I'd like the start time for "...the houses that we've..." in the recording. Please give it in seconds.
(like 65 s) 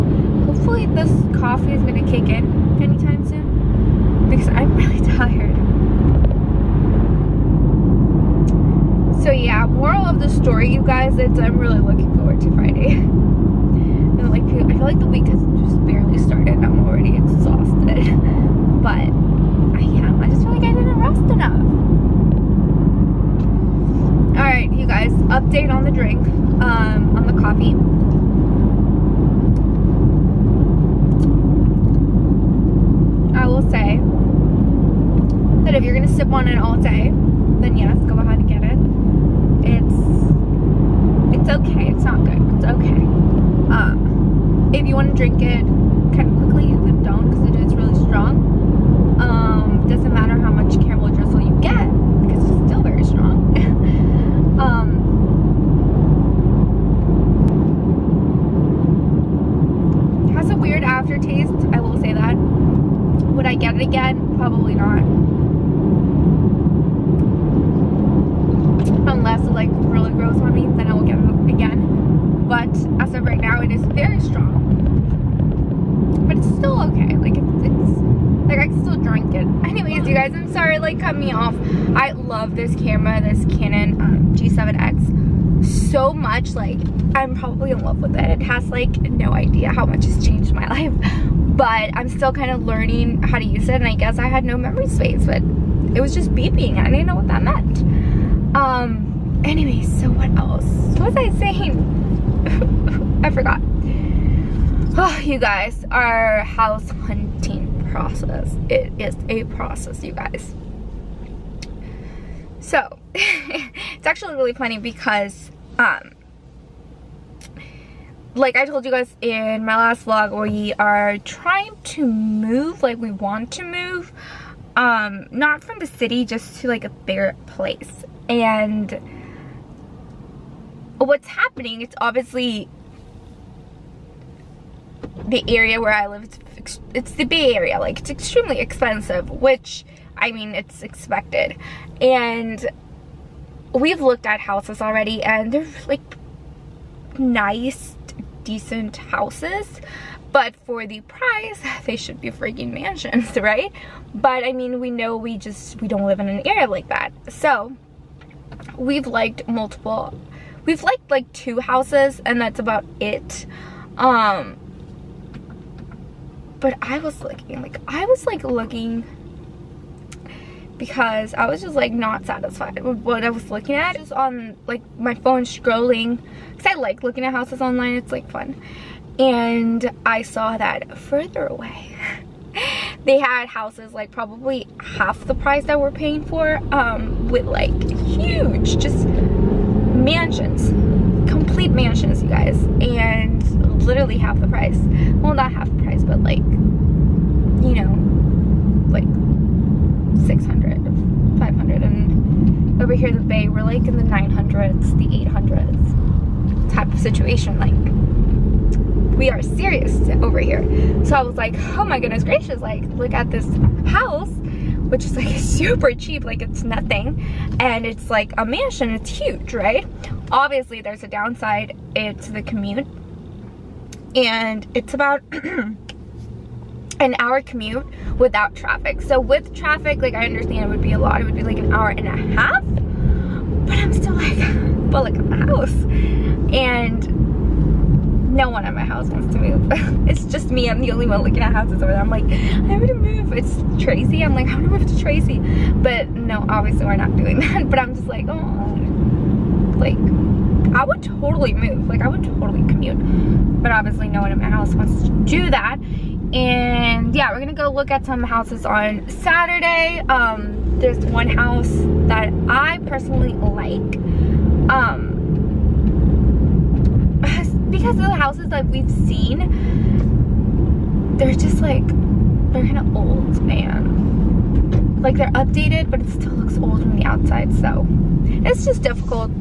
268 s.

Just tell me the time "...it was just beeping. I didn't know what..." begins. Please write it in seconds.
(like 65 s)
95 s.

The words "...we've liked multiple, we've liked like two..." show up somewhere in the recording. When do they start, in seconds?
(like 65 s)
158 s.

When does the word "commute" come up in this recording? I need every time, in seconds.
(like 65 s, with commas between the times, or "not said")
222 s, 227 s, 252 s.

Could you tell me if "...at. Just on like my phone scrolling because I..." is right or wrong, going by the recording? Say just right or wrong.
right.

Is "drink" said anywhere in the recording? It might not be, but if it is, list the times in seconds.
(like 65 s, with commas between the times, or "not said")
25 s, 45 s.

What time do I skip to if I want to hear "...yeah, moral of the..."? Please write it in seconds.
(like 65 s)
9 s.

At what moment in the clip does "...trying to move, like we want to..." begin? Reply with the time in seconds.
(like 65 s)
121 s.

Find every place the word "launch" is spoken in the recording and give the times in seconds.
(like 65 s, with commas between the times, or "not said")
not said.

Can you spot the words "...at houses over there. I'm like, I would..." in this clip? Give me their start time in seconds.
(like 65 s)
241 s.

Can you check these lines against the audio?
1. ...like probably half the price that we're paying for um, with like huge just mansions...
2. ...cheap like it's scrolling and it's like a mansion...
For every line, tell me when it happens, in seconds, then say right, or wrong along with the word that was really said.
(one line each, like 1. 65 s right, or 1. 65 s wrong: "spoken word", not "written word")
1. 183 s right
2. 215 s wrong: "nothing", not "scrolling".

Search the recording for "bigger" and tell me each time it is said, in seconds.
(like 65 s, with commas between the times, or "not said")
126 s.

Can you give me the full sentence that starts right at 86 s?
Like, I'm probably in love with it.